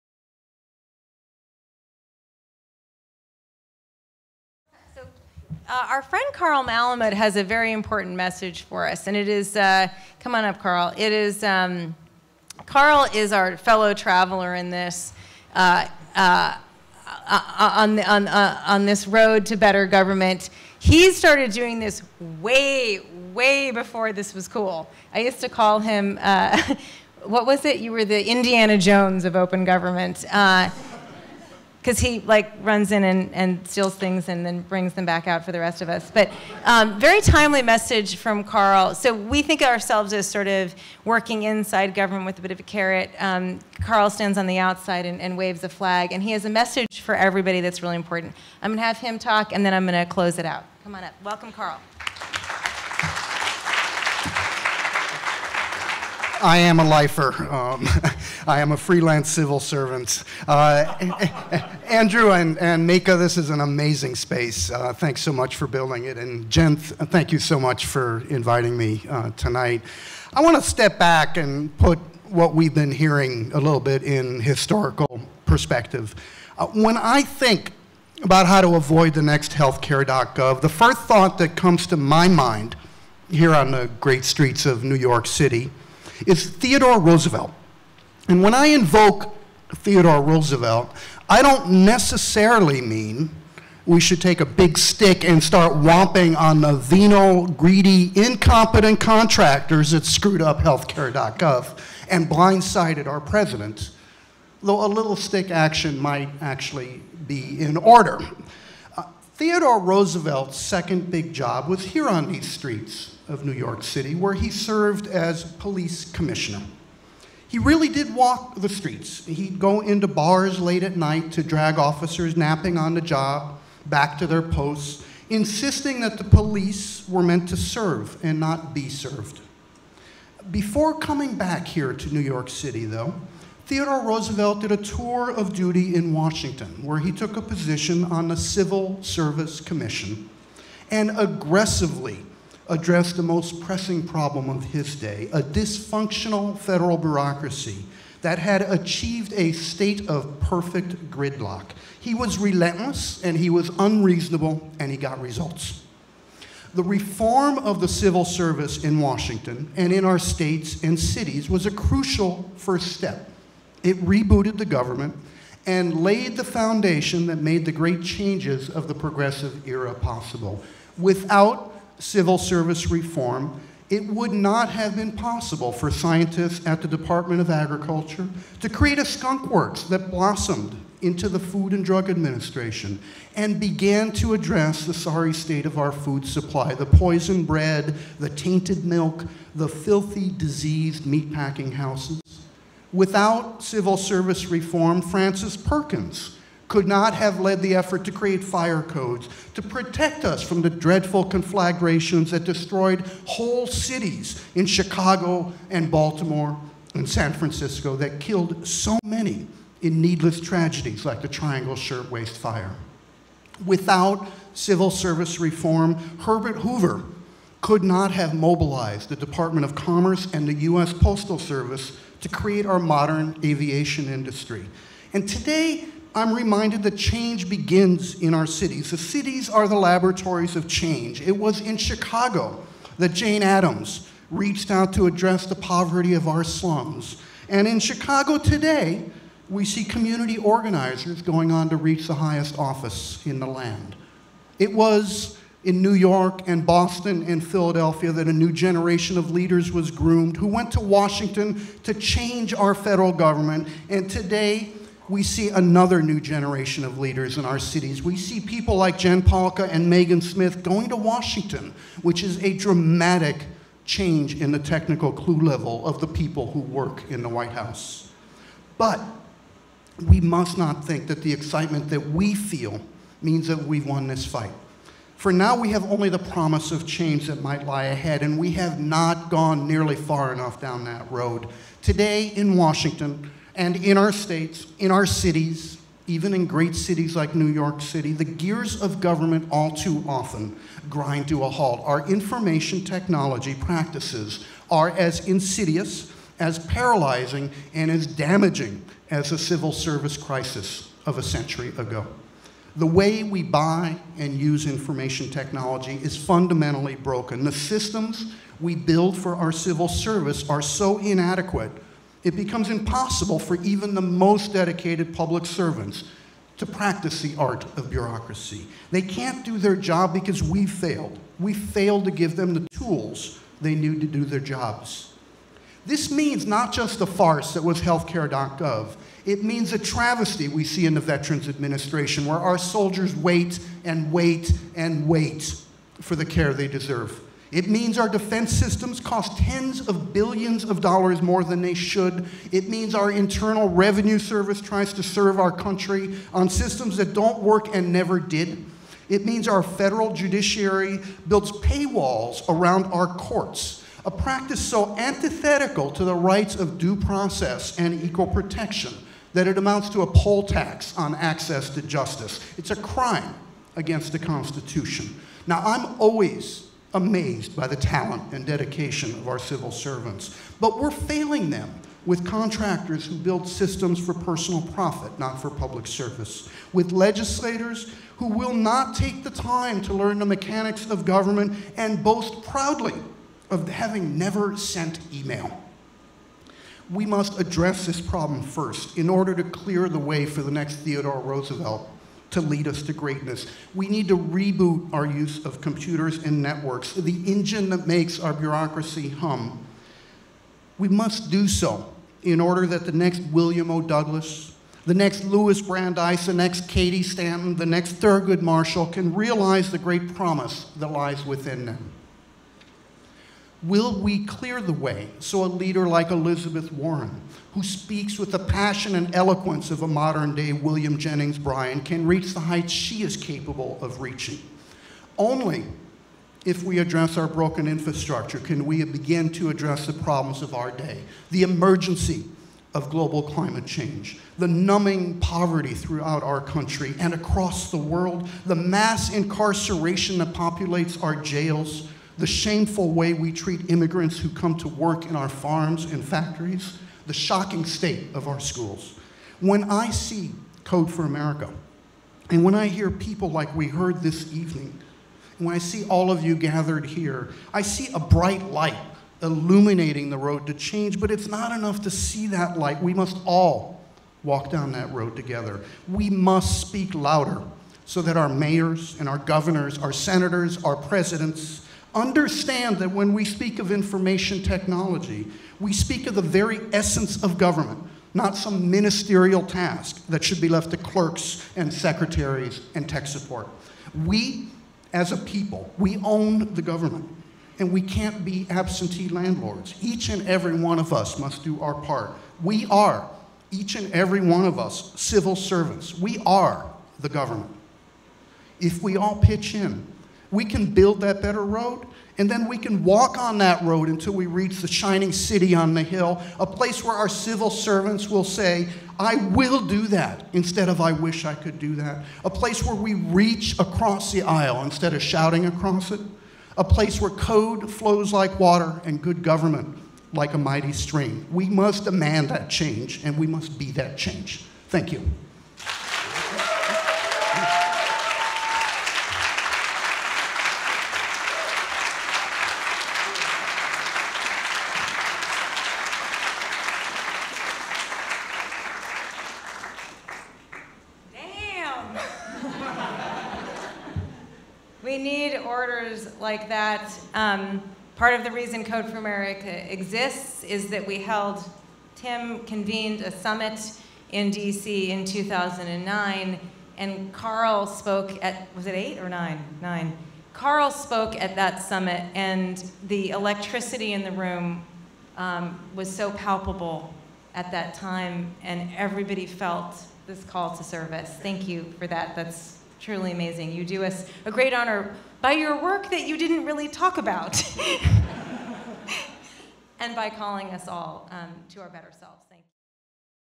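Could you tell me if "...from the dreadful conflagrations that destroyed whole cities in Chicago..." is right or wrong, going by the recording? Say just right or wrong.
right.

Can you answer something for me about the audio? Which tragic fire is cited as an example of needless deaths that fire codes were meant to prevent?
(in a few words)
Triangle Shirtwaist Fire.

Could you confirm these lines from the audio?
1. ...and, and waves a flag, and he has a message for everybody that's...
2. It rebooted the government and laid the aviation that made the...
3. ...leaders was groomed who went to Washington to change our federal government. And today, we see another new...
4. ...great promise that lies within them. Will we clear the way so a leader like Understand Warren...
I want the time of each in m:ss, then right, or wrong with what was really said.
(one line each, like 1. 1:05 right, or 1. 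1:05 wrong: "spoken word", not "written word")
1. 0:45 right
2. 2:43 wrong: "foundation", not "aviation"
3. 4:09 right
4. 6:49 wrong: "Elizabeth", not "Understand".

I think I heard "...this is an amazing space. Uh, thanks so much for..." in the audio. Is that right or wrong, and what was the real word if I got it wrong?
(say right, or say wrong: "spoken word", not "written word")
right.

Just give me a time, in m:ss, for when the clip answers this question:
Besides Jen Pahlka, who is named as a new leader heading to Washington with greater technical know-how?
4:19.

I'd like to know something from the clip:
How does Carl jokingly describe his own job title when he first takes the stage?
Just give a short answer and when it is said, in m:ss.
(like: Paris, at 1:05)
freelance civil servant, at 0:58.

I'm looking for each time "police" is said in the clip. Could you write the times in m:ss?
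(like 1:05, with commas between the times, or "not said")
1:55, 2:06.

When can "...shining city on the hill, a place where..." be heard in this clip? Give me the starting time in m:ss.
8:24.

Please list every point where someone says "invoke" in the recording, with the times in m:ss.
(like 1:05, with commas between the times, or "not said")
1:28.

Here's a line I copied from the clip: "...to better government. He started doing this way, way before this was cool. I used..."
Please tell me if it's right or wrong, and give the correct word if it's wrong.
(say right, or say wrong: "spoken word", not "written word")
right.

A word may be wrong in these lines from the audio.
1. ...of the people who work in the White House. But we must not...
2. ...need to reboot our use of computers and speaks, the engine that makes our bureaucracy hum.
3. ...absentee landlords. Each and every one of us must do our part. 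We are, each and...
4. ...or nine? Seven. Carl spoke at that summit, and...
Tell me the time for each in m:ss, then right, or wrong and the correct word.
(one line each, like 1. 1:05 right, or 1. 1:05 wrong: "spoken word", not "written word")
1. 4:25 right
2. 6:33 wrong: "networks", not "speaks"
3. 8:08 right
4. 9:18 wrong: "Nine", not "Seven".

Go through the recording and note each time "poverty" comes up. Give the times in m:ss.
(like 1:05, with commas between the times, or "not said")
3:55, 7:15.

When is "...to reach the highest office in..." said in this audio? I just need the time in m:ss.
4:01.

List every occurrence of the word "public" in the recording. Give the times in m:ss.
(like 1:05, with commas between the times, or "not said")
5:15, 6:15.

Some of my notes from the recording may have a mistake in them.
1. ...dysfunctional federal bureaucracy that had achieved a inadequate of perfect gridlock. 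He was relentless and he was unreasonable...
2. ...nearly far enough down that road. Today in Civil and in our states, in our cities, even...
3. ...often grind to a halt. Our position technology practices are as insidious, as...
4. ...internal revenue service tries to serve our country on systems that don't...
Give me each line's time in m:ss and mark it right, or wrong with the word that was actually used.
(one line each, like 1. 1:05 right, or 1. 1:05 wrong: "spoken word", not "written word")
1. 2:25 wrong: "state", not "inadequate"
2. 4:39 wrong: "Washington", not "Civil"
3. 4:50 wrong: "information", not "position"
4. 5:43 right.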